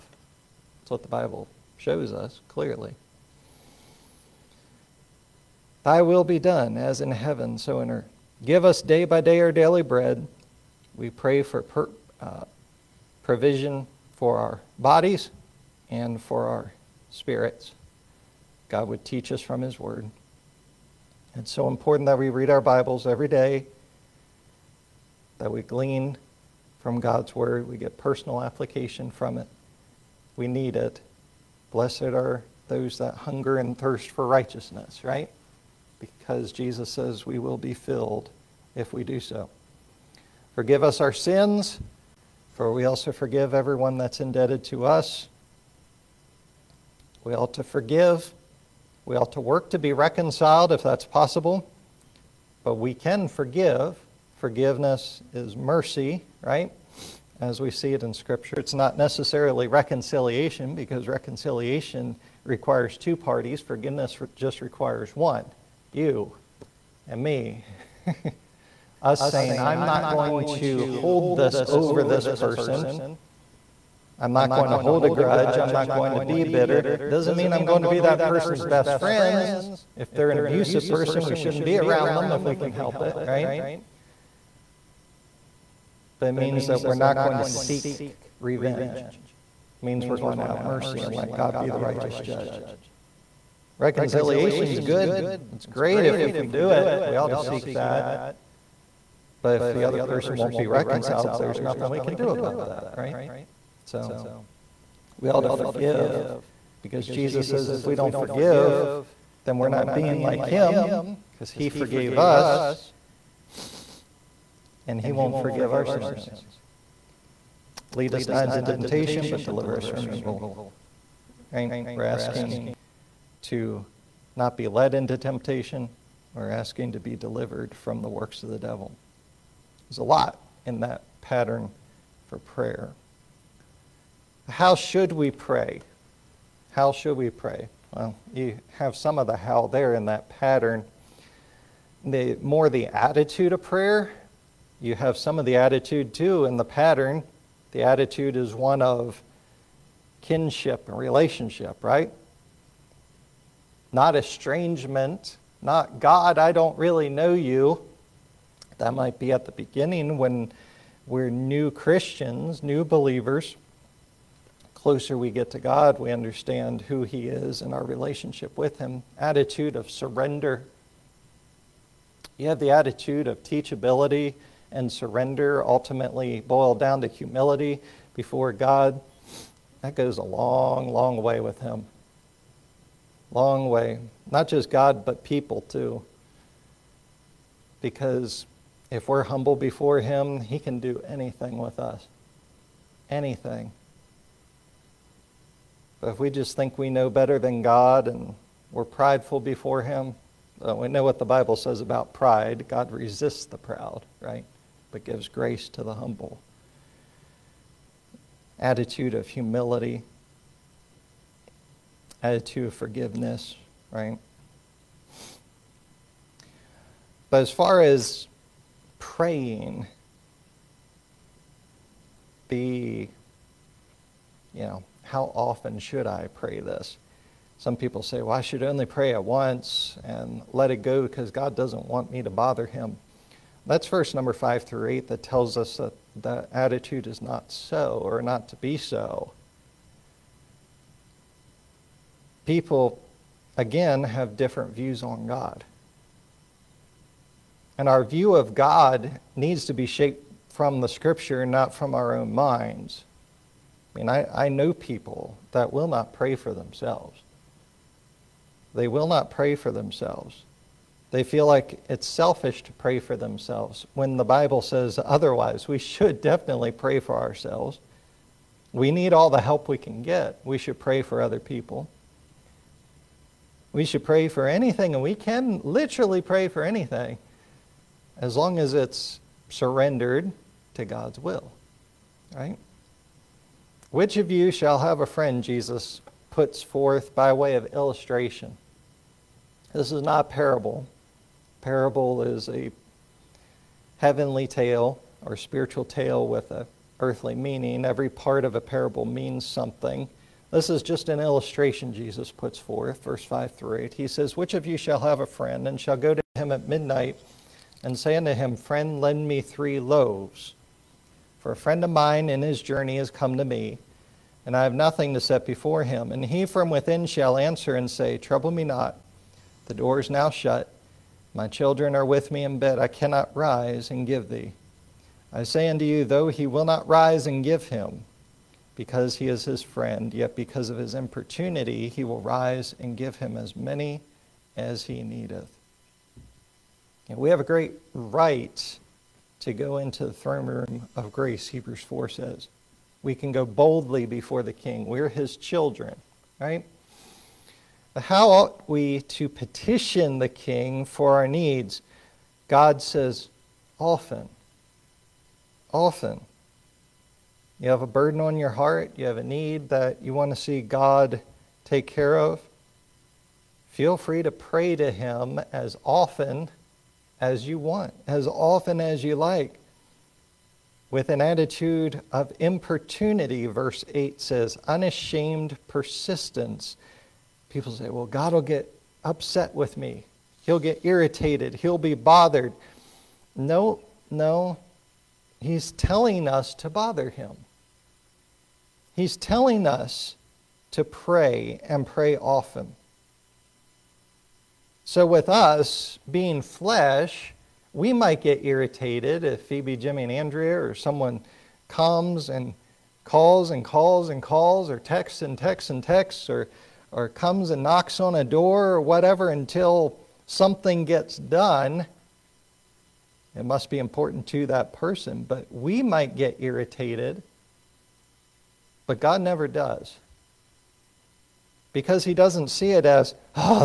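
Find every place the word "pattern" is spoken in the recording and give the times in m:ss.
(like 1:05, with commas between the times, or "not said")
2:11, 2:20, 2:26.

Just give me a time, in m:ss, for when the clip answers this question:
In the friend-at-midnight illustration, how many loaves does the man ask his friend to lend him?
5:09.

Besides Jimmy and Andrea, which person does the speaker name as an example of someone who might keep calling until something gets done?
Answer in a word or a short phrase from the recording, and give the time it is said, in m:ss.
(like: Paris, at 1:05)
Phoebe, at 6:39.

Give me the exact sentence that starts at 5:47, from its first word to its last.
But how ought we to petition the king for our needs?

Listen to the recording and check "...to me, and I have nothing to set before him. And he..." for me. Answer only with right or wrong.
right.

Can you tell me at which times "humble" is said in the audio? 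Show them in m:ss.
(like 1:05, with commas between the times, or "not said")
3:09, 3:25.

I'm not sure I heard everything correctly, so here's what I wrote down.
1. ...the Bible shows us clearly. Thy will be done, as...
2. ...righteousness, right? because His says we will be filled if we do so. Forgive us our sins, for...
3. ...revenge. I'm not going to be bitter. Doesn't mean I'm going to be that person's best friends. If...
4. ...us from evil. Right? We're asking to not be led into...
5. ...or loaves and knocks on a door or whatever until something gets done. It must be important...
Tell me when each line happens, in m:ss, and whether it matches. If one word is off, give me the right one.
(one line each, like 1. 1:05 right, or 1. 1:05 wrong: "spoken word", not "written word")
1. 0:01 right
2. 0:34 wrong: "Jesus", not "His"
3. 1:15 wrong: "grudge", not "revenge"
4. 1:59 right
5. 6:46 wrong: "comes", not "loaves".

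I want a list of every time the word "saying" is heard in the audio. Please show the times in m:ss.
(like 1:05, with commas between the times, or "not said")
1:09.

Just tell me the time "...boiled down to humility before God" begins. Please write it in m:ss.
2:56.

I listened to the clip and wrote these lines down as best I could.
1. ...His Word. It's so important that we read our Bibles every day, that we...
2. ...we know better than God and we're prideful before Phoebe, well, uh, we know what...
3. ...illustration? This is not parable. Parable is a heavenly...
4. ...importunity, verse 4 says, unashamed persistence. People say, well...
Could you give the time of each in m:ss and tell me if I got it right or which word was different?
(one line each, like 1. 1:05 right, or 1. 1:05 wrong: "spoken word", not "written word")
1. 0:19 right
2. 3:16 wrong: "Him", not "Phoebe"
3. 4:47 right
4. 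6:12 wrong: "8", not "4".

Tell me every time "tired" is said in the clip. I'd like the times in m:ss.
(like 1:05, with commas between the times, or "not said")
not said.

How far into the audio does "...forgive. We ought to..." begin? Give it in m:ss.
0:47.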